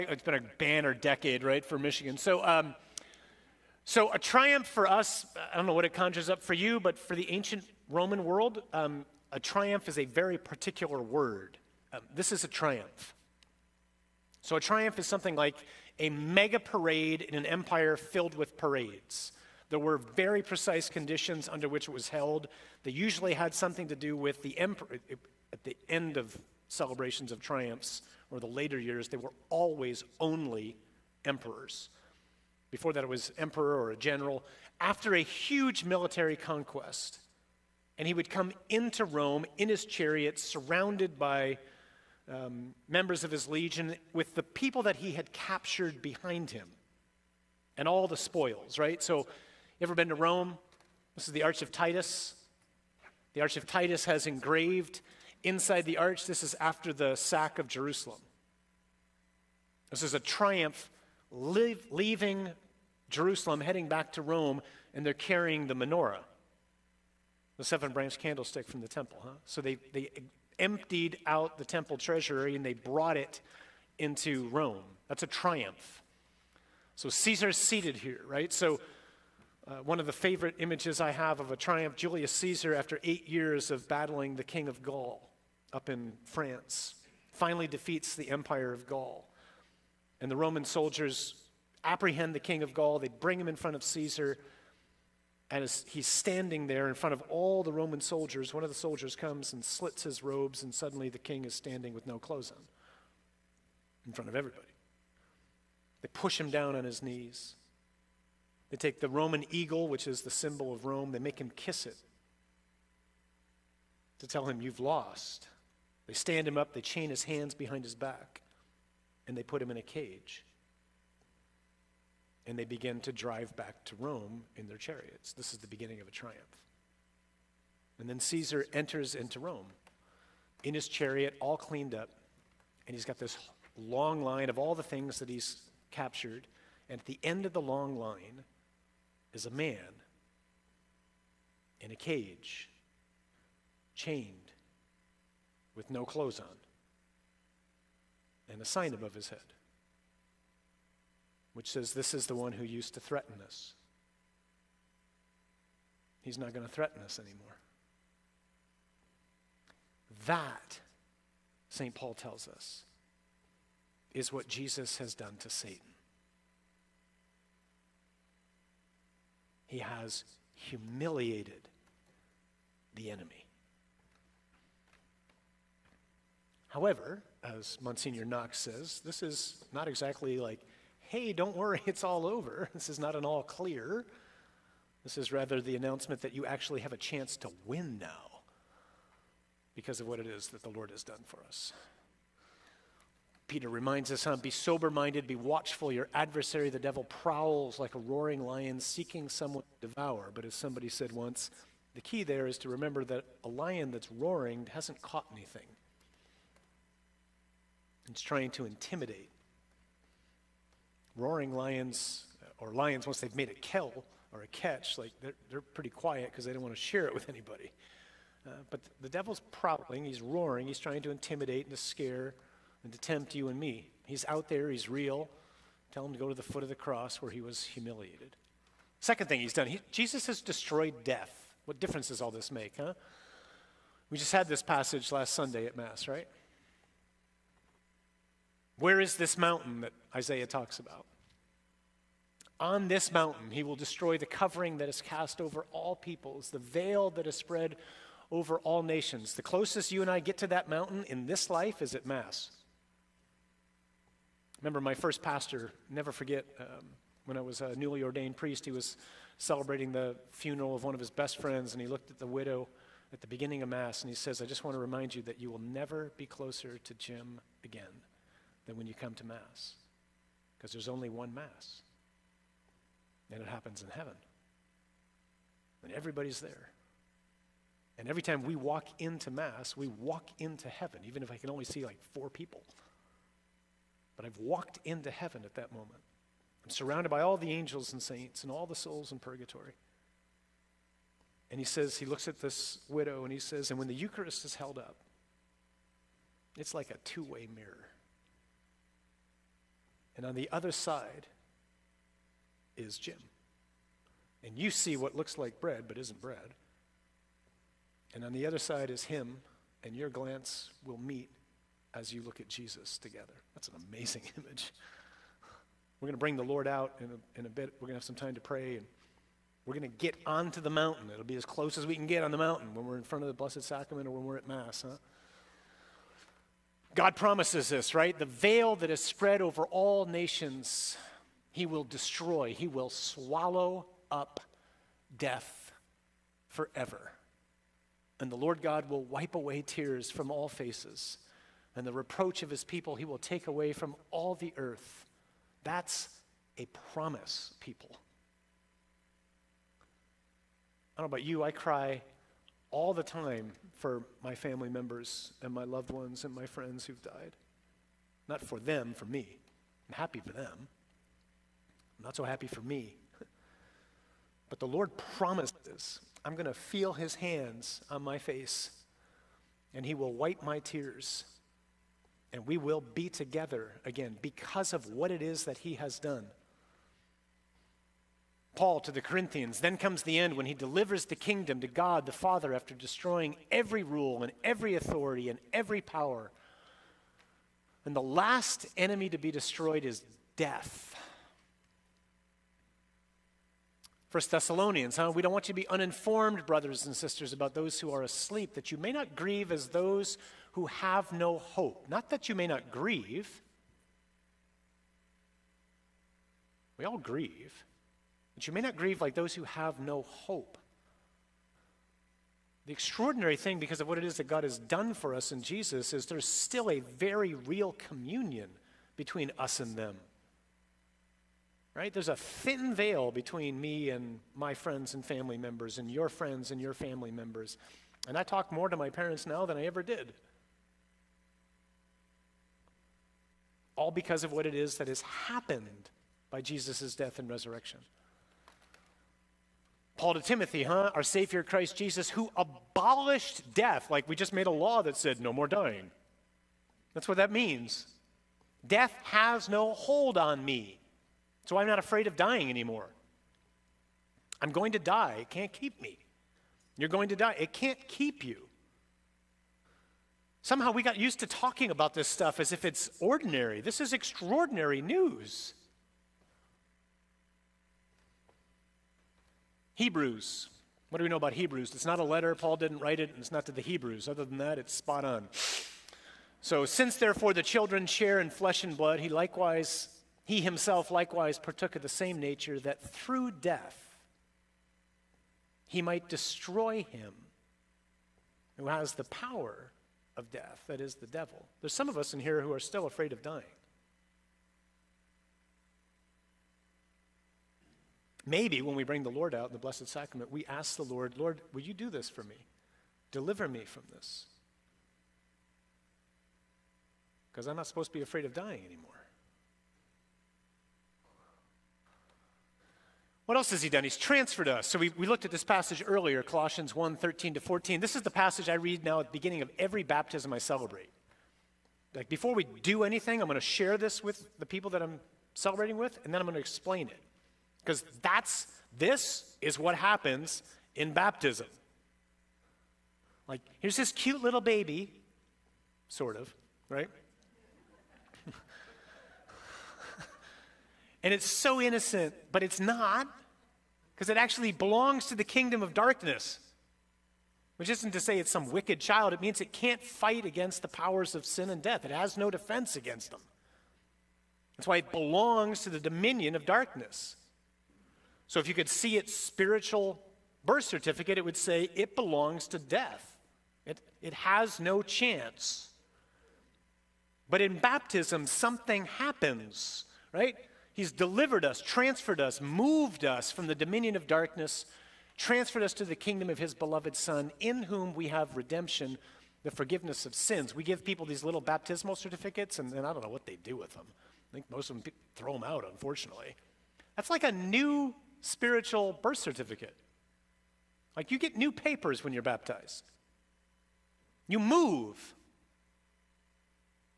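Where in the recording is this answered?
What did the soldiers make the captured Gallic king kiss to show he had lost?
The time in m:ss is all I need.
1:49.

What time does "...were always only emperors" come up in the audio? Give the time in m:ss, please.
0:29.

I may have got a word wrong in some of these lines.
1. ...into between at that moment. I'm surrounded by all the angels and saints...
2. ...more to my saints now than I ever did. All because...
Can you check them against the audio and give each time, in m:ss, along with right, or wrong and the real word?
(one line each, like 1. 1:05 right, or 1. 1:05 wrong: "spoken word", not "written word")
1. 4:44 wrong: "heaven", not "between"
2. 7:08 wrong: "parents", not "saints".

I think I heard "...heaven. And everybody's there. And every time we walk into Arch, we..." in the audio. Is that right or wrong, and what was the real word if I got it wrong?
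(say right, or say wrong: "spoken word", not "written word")
wrong: "Mass", not "Arch".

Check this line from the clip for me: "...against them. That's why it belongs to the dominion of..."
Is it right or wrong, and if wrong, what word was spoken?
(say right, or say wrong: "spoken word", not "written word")
right.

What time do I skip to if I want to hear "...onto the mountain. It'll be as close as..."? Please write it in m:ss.
5:20.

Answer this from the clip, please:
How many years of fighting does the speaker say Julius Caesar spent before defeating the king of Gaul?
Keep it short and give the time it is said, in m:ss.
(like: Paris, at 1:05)
8, at 1:23.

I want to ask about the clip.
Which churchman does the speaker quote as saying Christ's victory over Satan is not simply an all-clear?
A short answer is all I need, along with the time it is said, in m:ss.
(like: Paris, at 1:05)
Monsignor Knox, at 2:57.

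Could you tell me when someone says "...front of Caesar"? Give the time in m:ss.
1:33.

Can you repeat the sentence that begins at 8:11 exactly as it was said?
There's some of us in here who are still afraid of dying.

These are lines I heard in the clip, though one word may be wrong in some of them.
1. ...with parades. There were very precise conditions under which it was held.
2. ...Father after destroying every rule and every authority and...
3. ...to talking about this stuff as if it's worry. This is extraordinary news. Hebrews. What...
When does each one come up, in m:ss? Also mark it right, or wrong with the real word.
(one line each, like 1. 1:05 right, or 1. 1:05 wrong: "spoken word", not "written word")
1. 0:18 right
2. 6:22 right
3. 7:41 wrong: "ordinary", not "worry".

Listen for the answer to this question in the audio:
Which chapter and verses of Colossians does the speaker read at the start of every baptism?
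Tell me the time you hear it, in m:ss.
8:36.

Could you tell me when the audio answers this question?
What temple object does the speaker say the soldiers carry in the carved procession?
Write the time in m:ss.
1:05.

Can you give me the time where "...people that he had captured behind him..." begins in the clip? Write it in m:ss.
0:44.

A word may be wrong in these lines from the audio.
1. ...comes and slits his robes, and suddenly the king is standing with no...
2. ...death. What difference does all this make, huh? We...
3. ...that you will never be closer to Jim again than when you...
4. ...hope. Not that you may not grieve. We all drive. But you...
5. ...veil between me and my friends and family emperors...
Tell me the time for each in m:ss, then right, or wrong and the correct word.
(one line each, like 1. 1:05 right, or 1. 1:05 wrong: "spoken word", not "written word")
1. 1:39 right
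2. 3:51 right
3. 4:25 right
4. 6:41 wrong: "grieve", not "drive"
5. 7:02 wrong: "members", not "emperors".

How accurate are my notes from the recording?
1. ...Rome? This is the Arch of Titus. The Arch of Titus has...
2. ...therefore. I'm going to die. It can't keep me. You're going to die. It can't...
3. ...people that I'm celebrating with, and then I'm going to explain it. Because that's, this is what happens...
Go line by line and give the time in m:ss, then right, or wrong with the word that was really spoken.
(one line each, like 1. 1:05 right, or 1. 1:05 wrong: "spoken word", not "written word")
1. 0:50 right
2. 7:32 wrong: "anymore", not "therefore"
3. 8:44 right.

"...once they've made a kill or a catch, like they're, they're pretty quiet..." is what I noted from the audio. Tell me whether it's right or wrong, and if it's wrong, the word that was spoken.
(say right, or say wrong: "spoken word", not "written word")
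right.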